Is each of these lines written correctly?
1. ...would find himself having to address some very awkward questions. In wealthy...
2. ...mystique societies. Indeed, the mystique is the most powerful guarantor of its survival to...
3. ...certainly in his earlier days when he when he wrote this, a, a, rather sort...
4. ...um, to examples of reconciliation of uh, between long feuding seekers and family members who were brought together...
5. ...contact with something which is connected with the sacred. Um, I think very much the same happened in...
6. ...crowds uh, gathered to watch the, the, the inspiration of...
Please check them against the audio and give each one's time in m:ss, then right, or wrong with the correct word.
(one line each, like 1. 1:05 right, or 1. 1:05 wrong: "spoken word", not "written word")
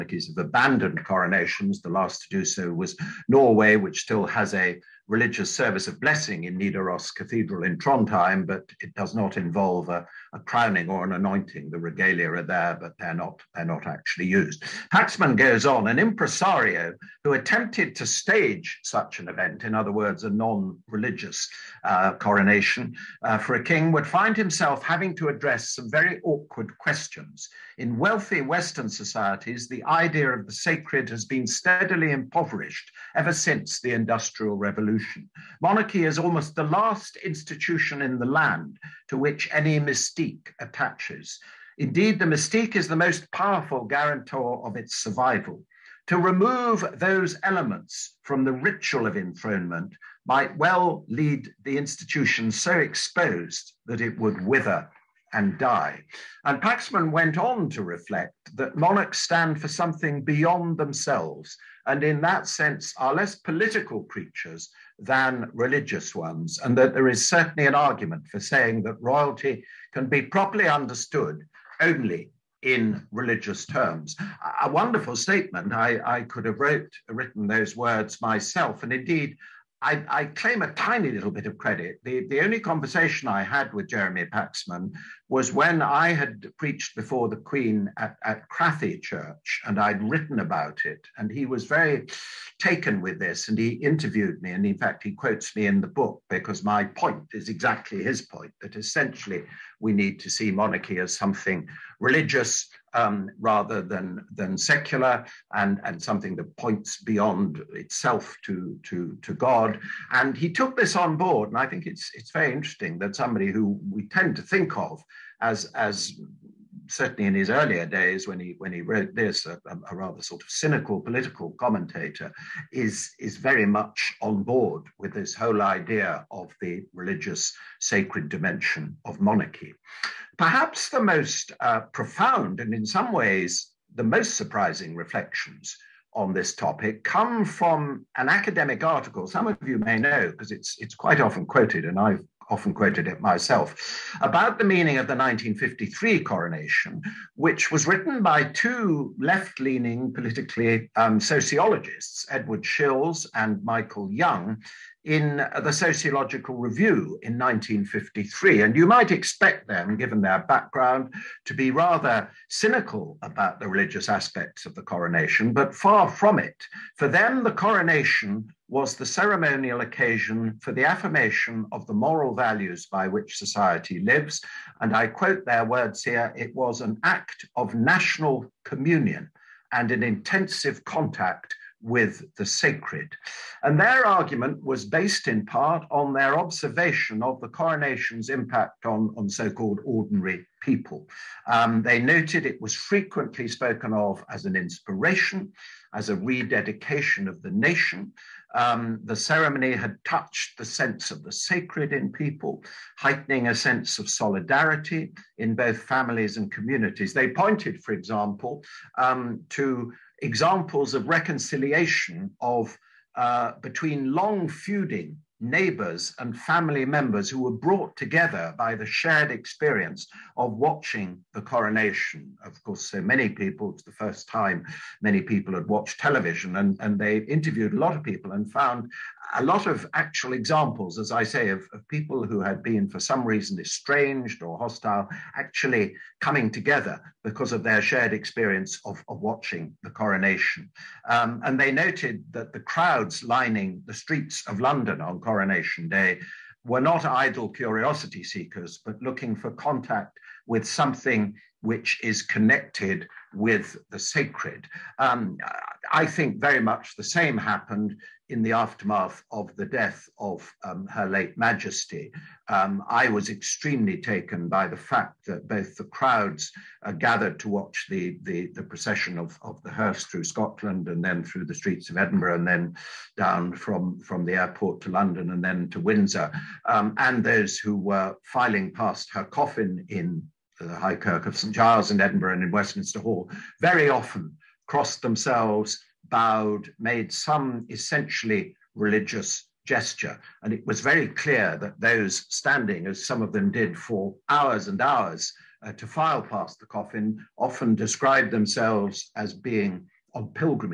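1. 0:23 right
2. 0:39 wrong: "attaches", not "societies"
3. 1:56 right
4. 3:28 wrong: "neighbors", not "seekers"
5. 4:09 right
6. 4:25 wrong: "procession", not "inspiration".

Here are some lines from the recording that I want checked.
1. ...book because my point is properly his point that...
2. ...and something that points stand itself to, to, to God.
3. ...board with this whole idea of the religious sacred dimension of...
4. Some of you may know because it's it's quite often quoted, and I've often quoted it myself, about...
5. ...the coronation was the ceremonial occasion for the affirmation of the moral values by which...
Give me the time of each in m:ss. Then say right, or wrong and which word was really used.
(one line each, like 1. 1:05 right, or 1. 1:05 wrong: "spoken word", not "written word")
1. 1:35 wrong: "exactly", not "properly"
2. 1:45 wrong: "beyond", not "stand"
3. 2:04 right
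4. 2:19 right
5. 2:47 right.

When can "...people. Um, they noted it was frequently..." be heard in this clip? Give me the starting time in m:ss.
3:10.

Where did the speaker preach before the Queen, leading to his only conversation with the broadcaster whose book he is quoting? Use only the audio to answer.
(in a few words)
Crathie Church.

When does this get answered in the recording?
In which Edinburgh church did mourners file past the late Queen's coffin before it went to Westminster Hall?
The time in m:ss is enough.
4:40.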